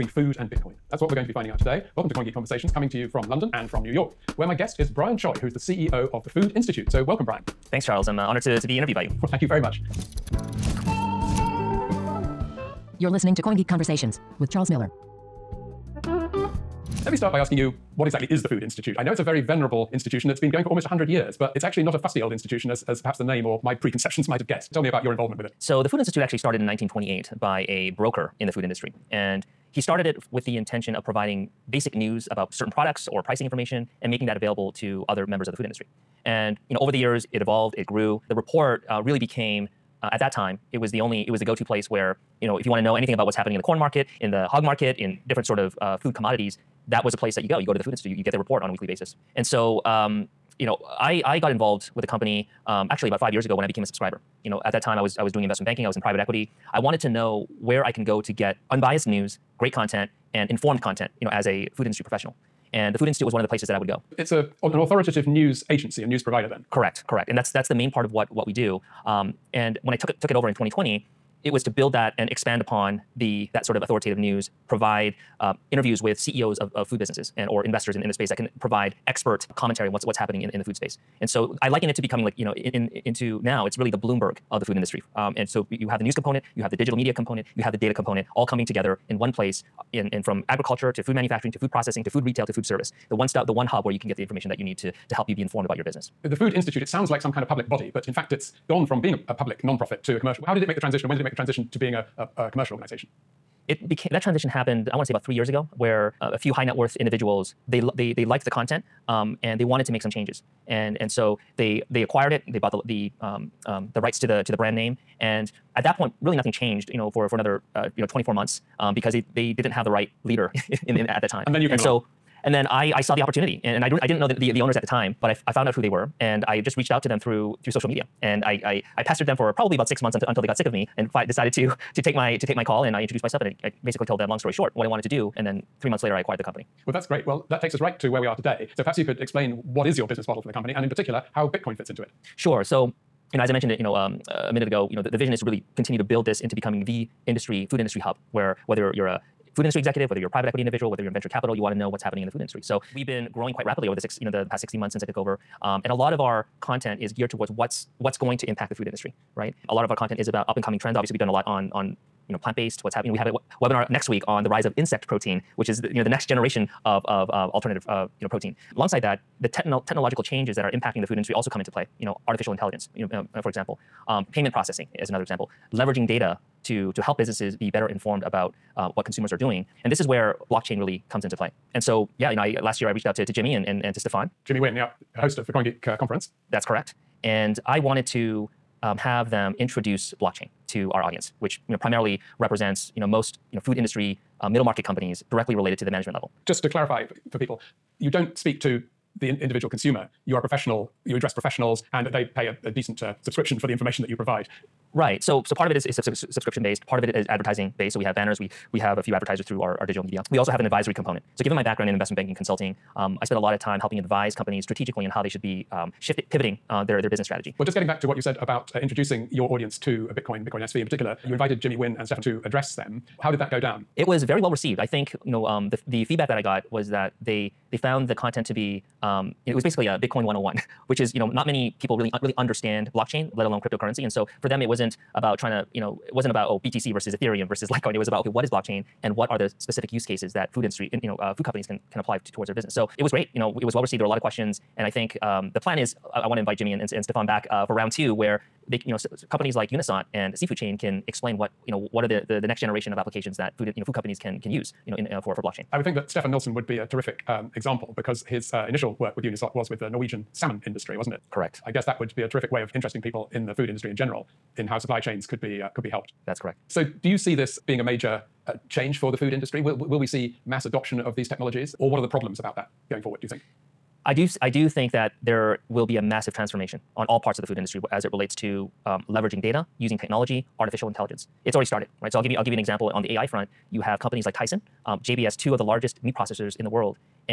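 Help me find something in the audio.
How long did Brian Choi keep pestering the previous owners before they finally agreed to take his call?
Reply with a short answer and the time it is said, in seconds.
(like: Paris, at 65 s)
About six months, at 129 s.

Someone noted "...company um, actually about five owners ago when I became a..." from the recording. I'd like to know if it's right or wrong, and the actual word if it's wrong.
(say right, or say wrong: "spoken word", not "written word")
wrong: "years", not "owners".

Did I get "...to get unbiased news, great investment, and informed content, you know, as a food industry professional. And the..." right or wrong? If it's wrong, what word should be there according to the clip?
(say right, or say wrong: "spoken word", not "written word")
wrong: "content", not "investment".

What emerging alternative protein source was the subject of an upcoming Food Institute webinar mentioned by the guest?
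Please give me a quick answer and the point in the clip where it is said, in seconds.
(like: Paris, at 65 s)
Insect protein, at 164 s.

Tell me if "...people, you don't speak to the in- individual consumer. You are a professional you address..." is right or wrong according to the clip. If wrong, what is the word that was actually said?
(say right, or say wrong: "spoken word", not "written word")
right.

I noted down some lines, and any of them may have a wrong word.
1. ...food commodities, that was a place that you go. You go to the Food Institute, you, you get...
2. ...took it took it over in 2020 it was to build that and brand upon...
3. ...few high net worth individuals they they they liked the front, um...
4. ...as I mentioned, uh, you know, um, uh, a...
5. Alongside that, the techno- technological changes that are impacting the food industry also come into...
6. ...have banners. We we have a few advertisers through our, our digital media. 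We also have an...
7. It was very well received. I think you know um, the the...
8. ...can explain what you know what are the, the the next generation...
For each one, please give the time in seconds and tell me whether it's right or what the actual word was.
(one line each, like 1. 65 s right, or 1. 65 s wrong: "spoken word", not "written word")
1. 45 s right
2. 69 s wrong: "expand", not "brand"
3. 106 s wrong: "content", not "front"
4. 143 s right
5. 168 s right
6. 208 s right
7. 223 s right
8. 250 s right.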